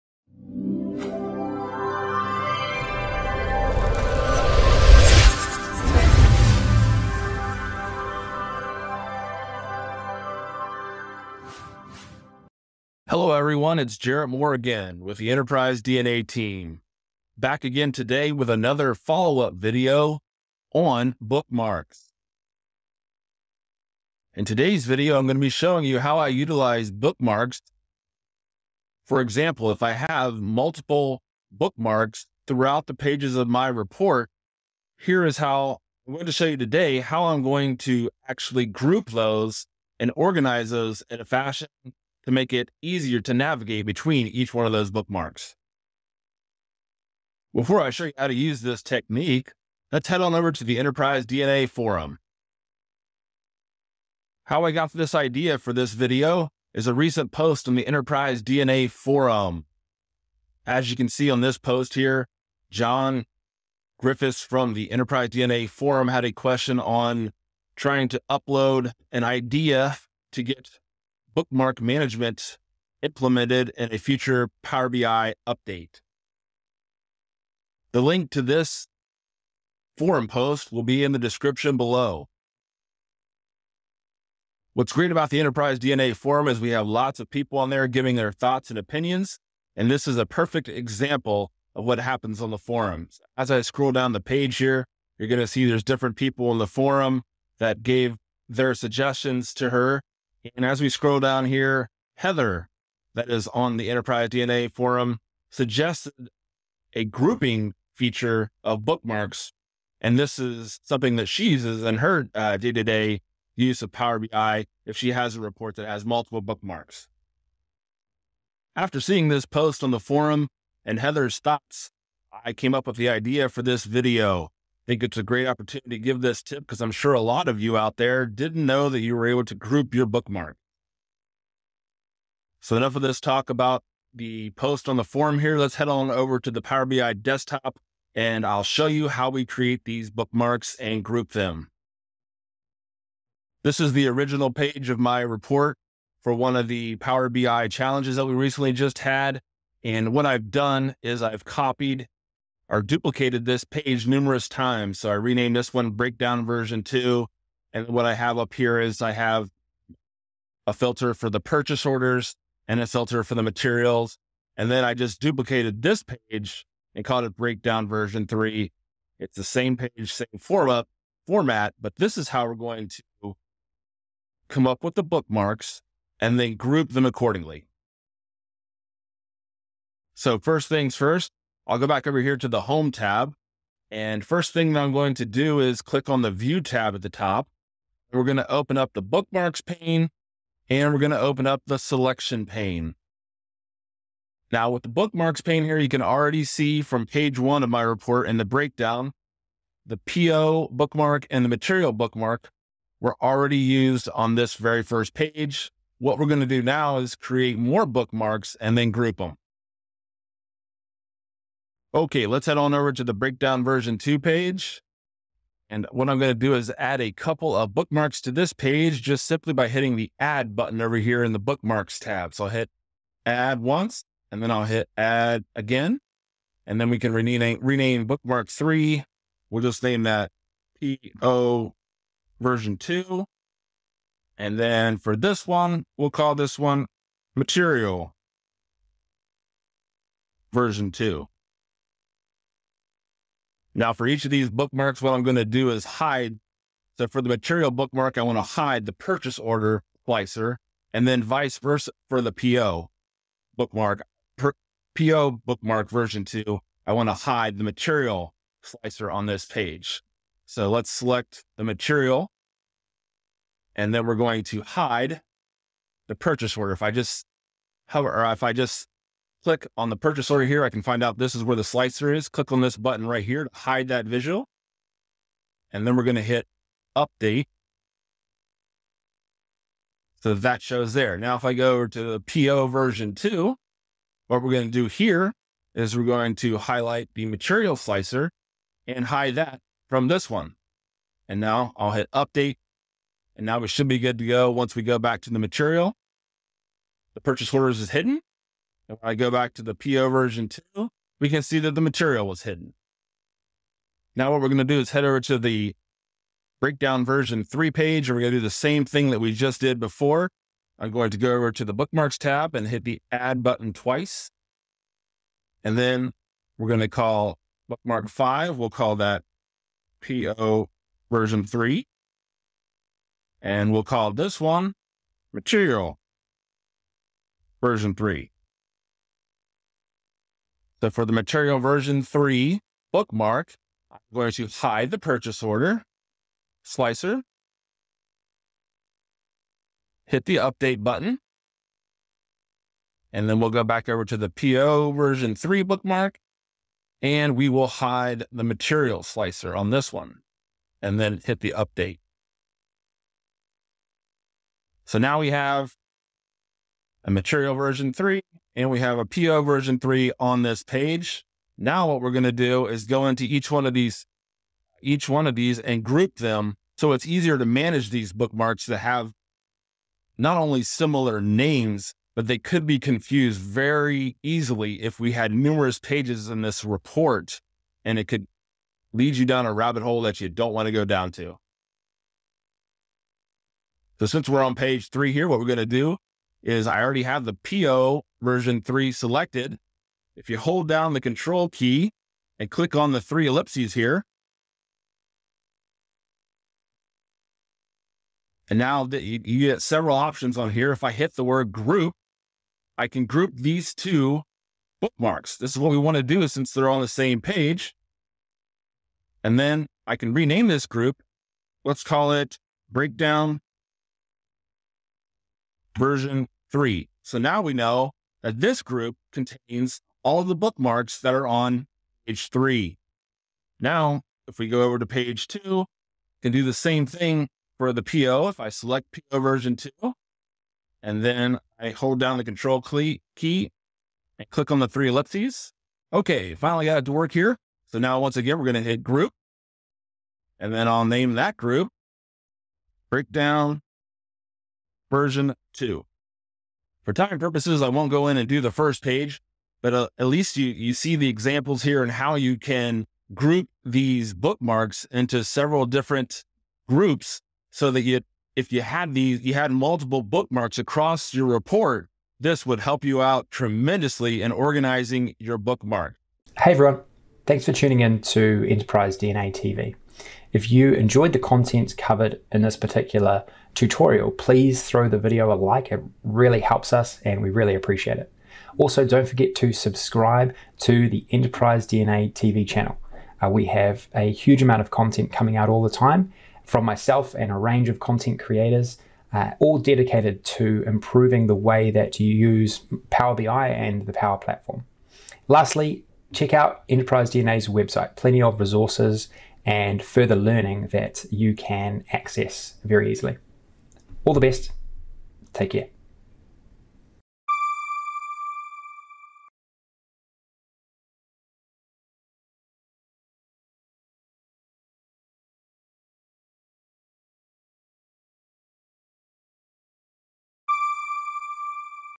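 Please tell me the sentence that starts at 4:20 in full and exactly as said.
So let's select the material and then we're going to hide the purchase order.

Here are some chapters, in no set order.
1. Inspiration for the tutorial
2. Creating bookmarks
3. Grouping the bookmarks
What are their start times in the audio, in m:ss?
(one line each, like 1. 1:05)
1. 0:53
2. 2:55
3. 6:33.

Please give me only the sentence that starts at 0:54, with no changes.
How I got this idea for this video is a recent post on the Enterprise DNA Forum.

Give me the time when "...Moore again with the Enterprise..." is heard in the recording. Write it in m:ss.
0:14.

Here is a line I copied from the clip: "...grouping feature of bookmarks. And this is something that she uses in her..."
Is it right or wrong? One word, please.
right.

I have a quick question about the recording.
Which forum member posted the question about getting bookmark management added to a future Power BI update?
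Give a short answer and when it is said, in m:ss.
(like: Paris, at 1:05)
John Griffiths, at 1:02.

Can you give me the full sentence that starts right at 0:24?
In today's video, I'm going to be showing you how I utilize bookmarks.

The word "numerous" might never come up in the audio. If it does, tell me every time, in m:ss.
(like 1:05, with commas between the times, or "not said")
2:34, 6:15.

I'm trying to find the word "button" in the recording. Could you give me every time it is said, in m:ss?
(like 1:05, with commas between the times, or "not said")
3:40, 4:32, 5:13, 5:40.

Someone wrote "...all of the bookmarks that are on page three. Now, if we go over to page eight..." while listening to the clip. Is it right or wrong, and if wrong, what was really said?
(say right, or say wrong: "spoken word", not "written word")
wrong: "two", not "eight".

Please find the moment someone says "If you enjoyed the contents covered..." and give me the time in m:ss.
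7:50.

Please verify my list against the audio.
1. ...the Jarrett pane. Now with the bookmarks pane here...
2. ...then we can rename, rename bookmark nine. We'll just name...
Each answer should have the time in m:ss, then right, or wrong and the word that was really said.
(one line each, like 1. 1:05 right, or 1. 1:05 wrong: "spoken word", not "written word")
1. 3:11 wrong: "Selection", not "Jarrett"
2. 3:46 wrong: "three", not "nine".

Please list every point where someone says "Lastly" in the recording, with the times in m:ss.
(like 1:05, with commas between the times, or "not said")
8:15.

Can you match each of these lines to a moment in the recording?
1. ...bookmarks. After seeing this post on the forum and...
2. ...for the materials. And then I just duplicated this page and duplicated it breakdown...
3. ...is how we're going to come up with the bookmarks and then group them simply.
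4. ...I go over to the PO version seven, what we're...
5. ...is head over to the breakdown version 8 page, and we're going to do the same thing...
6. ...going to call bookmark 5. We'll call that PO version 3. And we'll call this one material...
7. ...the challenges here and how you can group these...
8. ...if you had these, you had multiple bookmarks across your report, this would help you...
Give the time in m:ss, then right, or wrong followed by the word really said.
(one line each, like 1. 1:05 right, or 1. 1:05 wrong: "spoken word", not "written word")
1. 1:56 right
2. 2:43 wrong: "called", not "duplicated"
3. 2:52 wrong: "accordingly", not "simply"
4. 4:41 wrong: "two", not "seven"
5. 5:04 wrong: "3", not "8"
6. 5:16 right
7. 7:30 wrong: "examples", not "challenges"
8. 7:38 right.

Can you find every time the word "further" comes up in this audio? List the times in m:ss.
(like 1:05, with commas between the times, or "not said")
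8:19.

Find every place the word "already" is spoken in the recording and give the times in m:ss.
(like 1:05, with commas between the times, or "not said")
3:16, 3:23, 6:26.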